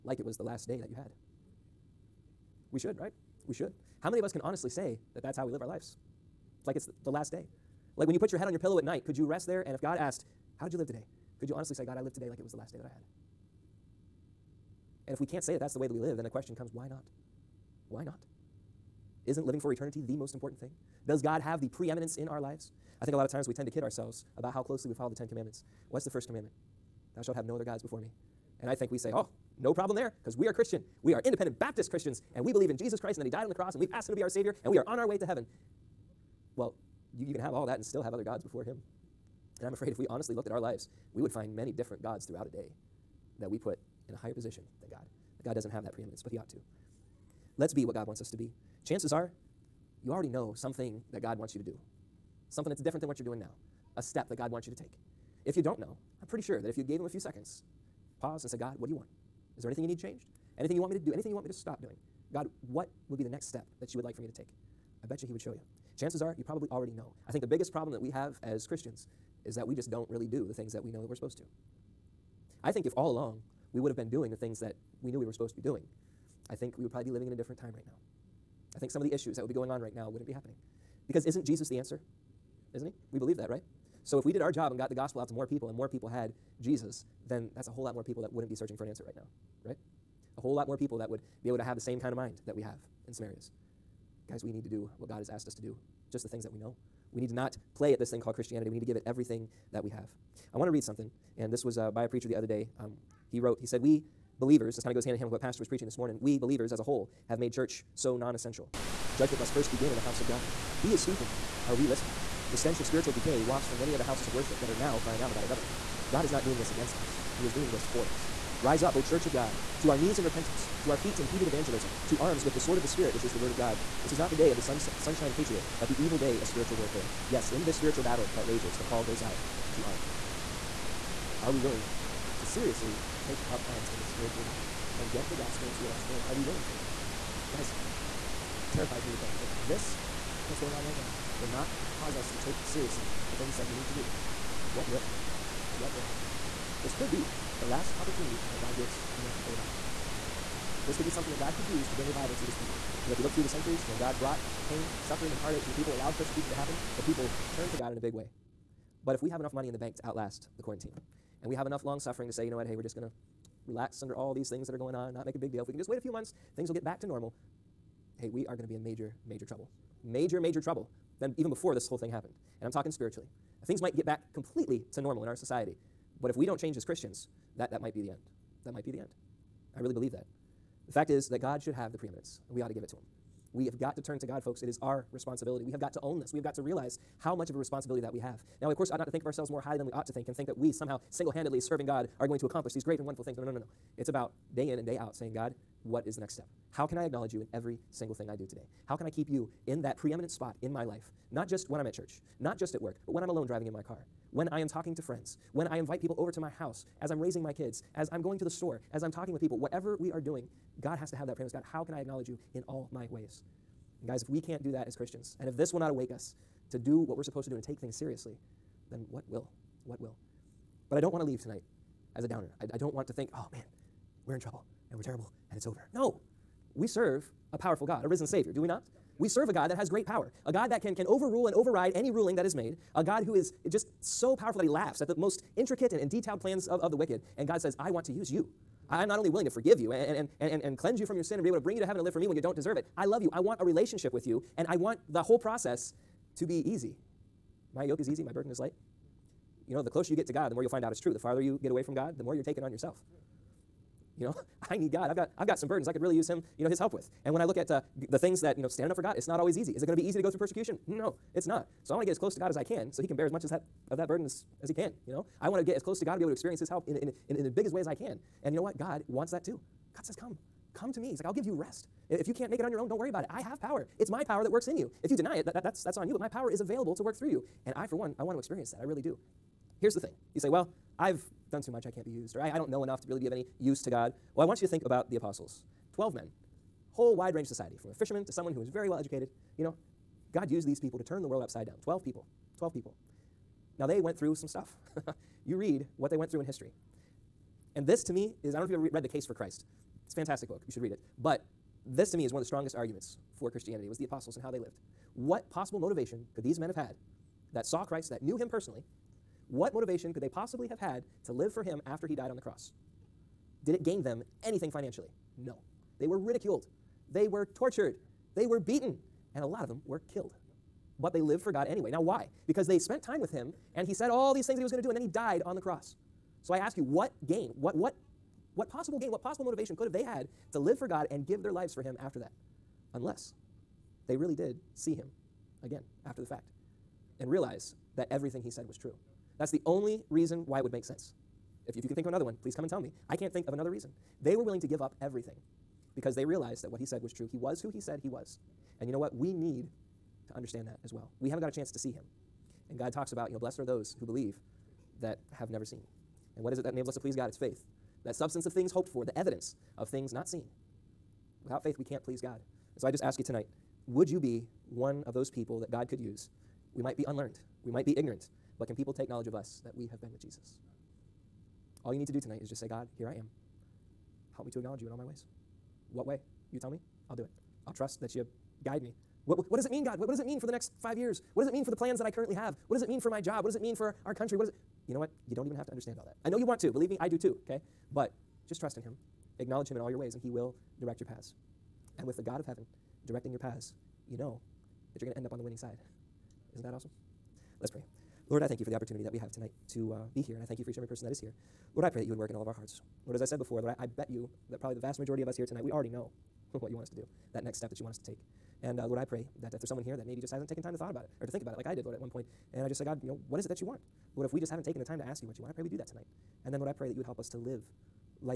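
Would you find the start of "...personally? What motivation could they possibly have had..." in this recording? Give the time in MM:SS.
05:08.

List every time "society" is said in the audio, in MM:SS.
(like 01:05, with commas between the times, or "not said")
02:55, 04:47.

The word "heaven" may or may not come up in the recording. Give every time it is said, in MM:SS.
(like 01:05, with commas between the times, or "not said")
00:35, 04:01, 06:32.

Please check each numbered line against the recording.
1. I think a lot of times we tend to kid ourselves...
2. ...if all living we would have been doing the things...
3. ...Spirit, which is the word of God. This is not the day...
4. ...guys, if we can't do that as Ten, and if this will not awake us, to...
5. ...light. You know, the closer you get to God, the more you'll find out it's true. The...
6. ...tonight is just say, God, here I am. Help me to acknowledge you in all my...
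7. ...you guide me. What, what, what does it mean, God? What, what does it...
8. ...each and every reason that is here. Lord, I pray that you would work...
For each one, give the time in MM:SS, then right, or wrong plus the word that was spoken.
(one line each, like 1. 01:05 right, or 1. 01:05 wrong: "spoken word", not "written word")
1. 00:23 right
2. 01:12 wrong: "along", not "living"
3. 02:02 right
4. 03:34 wrong: "Christians", not "Ten"
5. 04:08 right
6. 06:12 right
7. 06:18 right
8. 06:40 wrong: "person", not "reason".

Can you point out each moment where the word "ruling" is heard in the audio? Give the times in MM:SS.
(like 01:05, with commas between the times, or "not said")
03:52.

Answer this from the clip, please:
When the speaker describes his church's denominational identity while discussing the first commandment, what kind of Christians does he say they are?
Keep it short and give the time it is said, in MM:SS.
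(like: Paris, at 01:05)
Independent Baptist, at 00:31.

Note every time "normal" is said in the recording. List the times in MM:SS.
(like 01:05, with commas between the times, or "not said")
02:47, 02:55.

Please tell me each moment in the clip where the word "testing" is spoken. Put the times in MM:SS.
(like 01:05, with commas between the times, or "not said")
not said.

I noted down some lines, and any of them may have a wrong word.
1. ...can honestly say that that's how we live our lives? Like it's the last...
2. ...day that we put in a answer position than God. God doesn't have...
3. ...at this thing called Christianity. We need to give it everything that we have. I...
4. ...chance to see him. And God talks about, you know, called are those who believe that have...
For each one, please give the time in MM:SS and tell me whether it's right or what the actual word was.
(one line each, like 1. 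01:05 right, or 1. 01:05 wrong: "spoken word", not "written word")
1. 00:04 right
2. 00:42 wrong: "higher", not "answer"
3. 01:37 right
4. 05:51 wrong: "blessed", not "called".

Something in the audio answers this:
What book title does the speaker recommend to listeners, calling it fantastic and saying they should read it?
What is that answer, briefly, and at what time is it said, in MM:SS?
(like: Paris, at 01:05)
The Case for Christ, at 04:59.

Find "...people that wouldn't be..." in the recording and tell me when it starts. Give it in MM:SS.
01:28.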